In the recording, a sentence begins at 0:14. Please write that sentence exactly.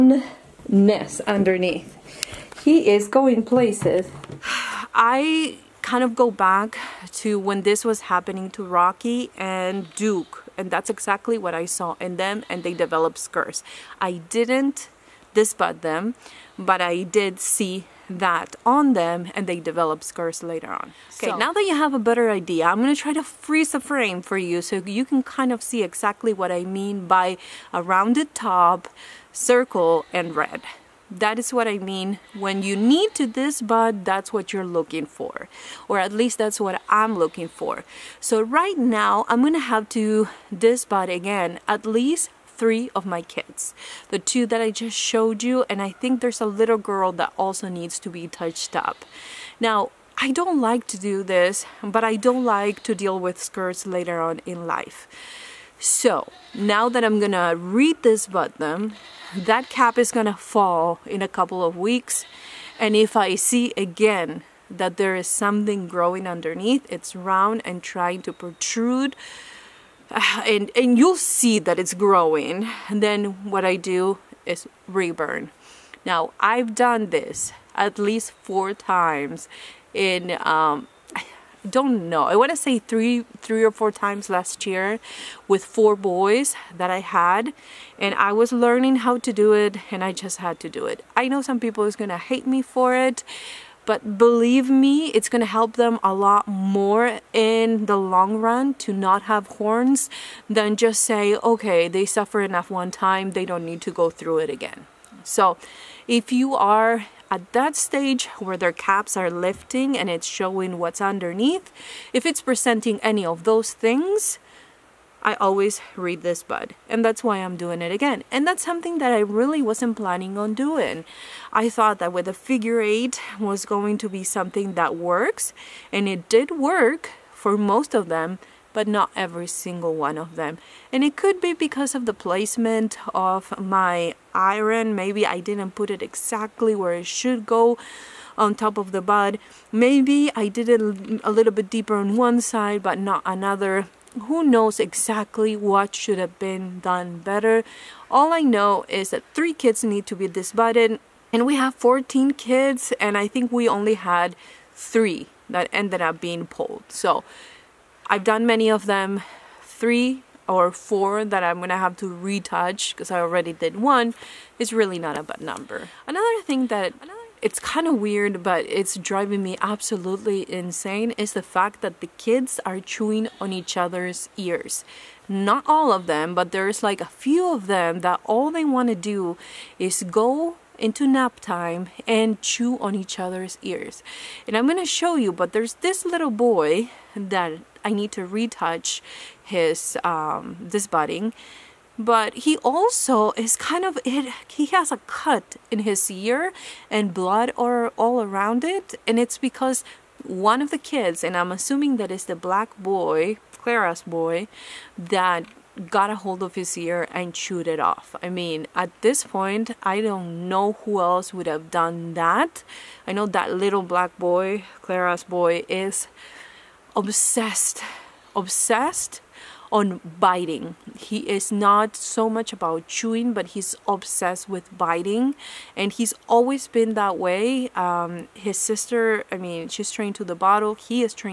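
I didn't dispatch them, but I did see that on them and they develop scars later on.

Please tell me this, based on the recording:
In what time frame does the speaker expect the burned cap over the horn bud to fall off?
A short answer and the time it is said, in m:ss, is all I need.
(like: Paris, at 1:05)
a couple of weeks, at 1:01.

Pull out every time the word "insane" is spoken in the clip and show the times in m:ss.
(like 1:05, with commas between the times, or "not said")
2:50.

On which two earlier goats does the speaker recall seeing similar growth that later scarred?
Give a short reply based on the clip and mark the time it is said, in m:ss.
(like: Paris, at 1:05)
Rocky and Duke, at 0:08.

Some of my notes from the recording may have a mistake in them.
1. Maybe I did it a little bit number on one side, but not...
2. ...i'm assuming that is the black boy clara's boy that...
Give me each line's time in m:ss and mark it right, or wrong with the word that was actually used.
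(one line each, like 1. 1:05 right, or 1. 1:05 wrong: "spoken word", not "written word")
1. 2:19 wrong: "deeper", not "number"
2. 3:21 right.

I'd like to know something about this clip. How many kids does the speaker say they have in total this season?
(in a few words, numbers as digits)
14.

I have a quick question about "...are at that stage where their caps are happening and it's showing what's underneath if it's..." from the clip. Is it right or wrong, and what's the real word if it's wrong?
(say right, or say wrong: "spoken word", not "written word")
wrong: "lifting", not "happening".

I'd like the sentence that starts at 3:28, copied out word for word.
I mean, at this point, I don't know who else would have done that.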